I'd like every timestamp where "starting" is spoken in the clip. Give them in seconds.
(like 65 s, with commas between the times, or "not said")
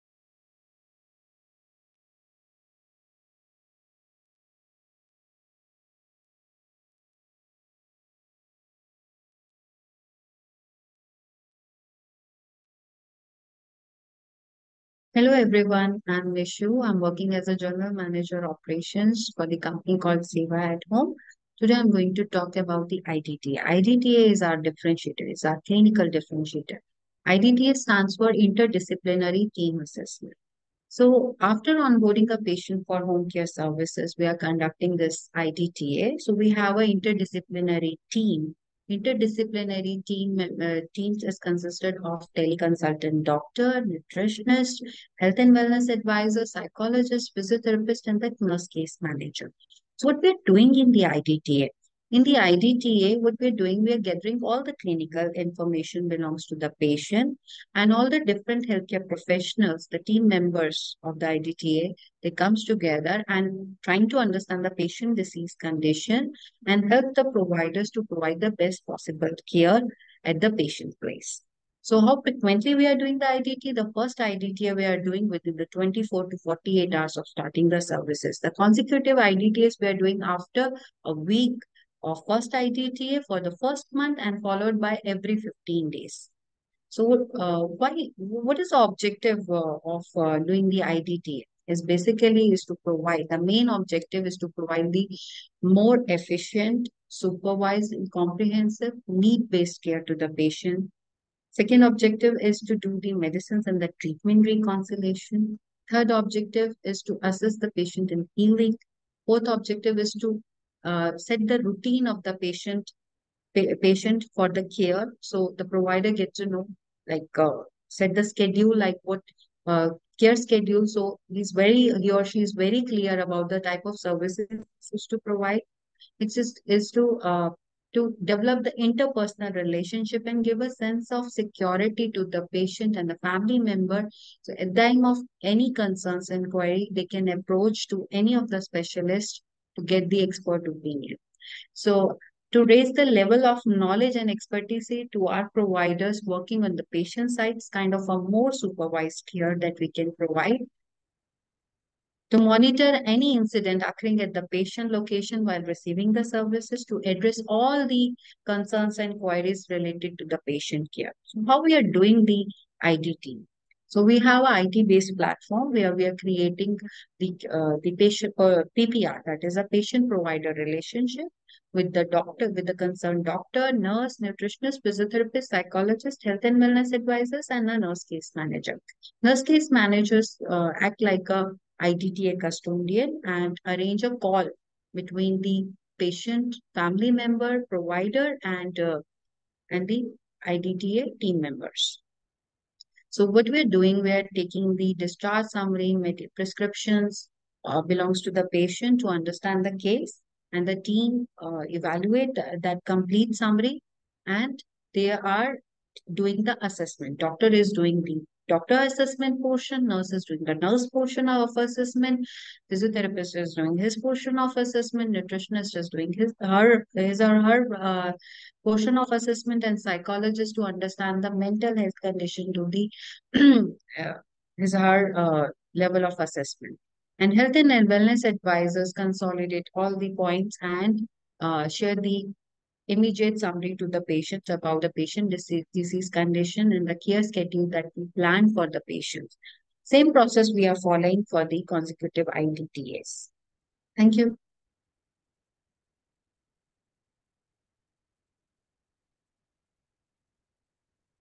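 77 s.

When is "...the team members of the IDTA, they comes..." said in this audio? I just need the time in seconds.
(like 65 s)
59 s.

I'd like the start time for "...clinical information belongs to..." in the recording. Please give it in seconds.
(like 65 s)
54 s.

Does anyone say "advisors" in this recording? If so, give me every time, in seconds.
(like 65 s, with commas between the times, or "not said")
45 s, 176 s, 228 s.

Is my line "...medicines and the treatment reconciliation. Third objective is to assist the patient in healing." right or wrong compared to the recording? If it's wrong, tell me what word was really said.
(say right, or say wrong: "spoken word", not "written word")
right.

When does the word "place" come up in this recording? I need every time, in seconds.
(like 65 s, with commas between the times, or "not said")
71 s.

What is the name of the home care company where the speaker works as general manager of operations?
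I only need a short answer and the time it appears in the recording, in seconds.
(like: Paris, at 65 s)
Seva at Home, at 20 s.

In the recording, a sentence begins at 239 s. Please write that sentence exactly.
Same process we are following for the consecutive IDTS.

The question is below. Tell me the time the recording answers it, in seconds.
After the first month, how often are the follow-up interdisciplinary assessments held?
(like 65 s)
85 s.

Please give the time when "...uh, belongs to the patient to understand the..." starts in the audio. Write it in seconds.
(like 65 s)
197 s.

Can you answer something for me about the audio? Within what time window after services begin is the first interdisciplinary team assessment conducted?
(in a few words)
24 to 48 hours.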